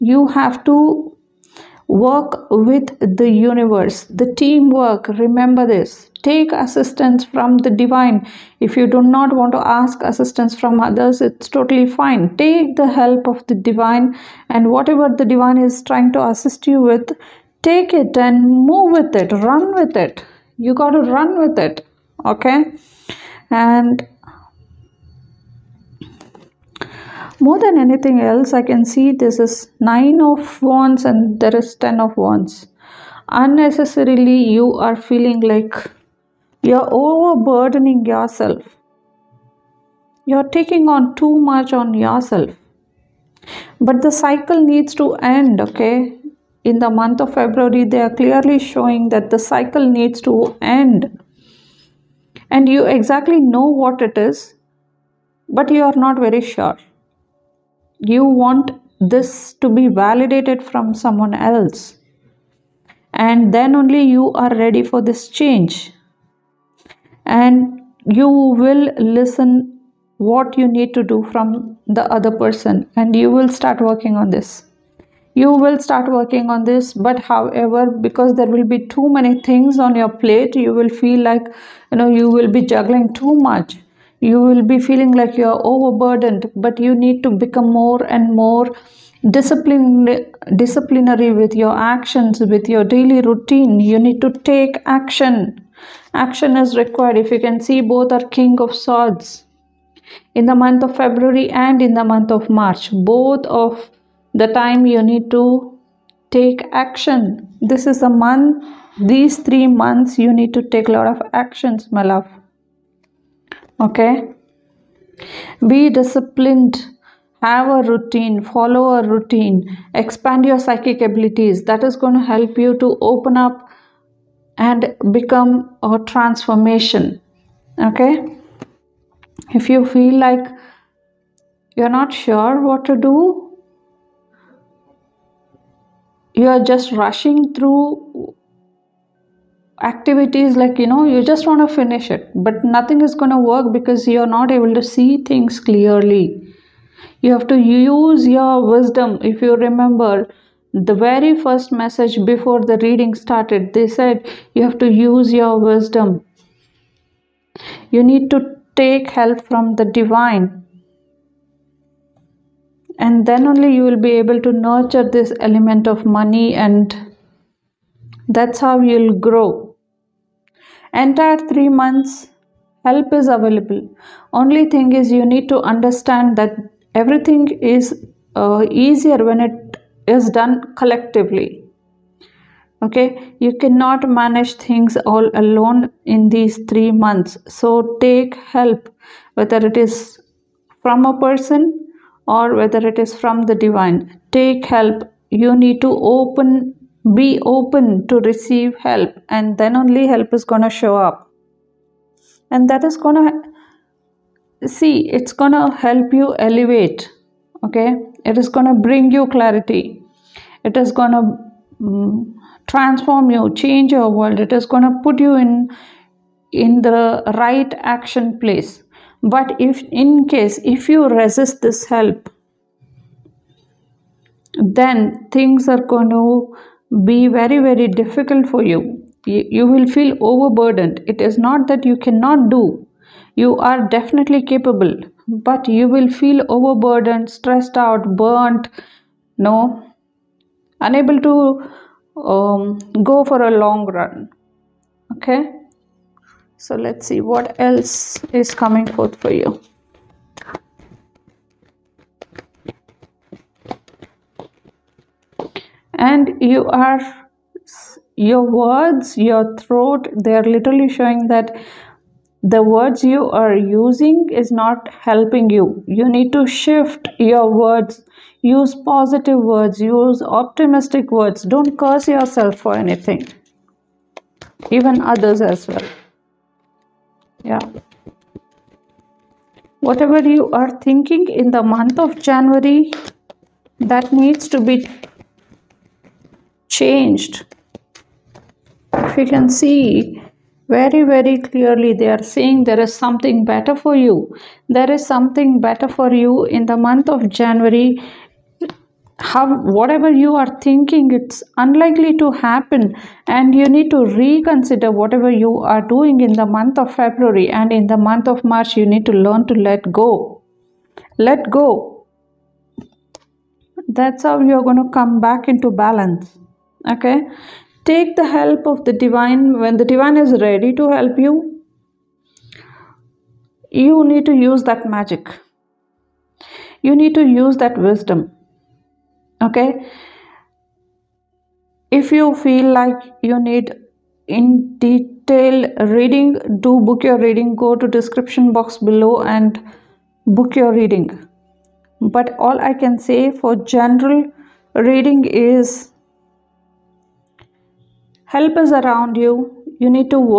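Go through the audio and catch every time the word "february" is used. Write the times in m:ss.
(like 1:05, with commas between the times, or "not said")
0:47, 1:40, 5:06.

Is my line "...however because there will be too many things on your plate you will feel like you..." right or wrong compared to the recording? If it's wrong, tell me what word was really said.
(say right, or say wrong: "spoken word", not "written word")
right.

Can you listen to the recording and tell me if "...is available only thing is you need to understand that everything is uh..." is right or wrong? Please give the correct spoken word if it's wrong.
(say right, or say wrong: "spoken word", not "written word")
right.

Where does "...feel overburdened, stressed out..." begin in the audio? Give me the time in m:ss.
3:56.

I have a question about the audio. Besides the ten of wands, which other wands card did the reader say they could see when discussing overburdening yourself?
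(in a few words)
9 of wands.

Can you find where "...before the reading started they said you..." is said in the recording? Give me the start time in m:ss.
2:32.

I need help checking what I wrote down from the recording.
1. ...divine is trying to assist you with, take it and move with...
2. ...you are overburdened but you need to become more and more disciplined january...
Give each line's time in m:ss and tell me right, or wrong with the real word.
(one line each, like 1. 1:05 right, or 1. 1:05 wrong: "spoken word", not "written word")
1. 0:15 right
2. 1:25 wrong: "disciplinary", not "january".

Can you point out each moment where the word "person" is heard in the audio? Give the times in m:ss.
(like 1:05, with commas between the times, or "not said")
1:12, 3:11.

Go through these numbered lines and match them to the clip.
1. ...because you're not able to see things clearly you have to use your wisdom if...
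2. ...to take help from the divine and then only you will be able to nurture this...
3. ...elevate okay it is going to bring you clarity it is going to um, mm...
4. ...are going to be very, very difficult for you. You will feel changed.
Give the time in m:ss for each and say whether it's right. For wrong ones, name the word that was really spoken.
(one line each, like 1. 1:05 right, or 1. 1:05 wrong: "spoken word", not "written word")
1. 2:23 right
2. 2:38 right
3. 3:26 right
4. 3:45 wrong: "overburdened", not "changed".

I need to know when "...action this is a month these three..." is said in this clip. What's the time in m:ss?
1:46.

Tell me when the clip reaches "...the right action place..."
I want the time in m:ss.
3:36.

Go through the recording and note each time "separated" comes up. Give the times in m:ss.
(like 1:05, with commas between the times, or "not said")
not said.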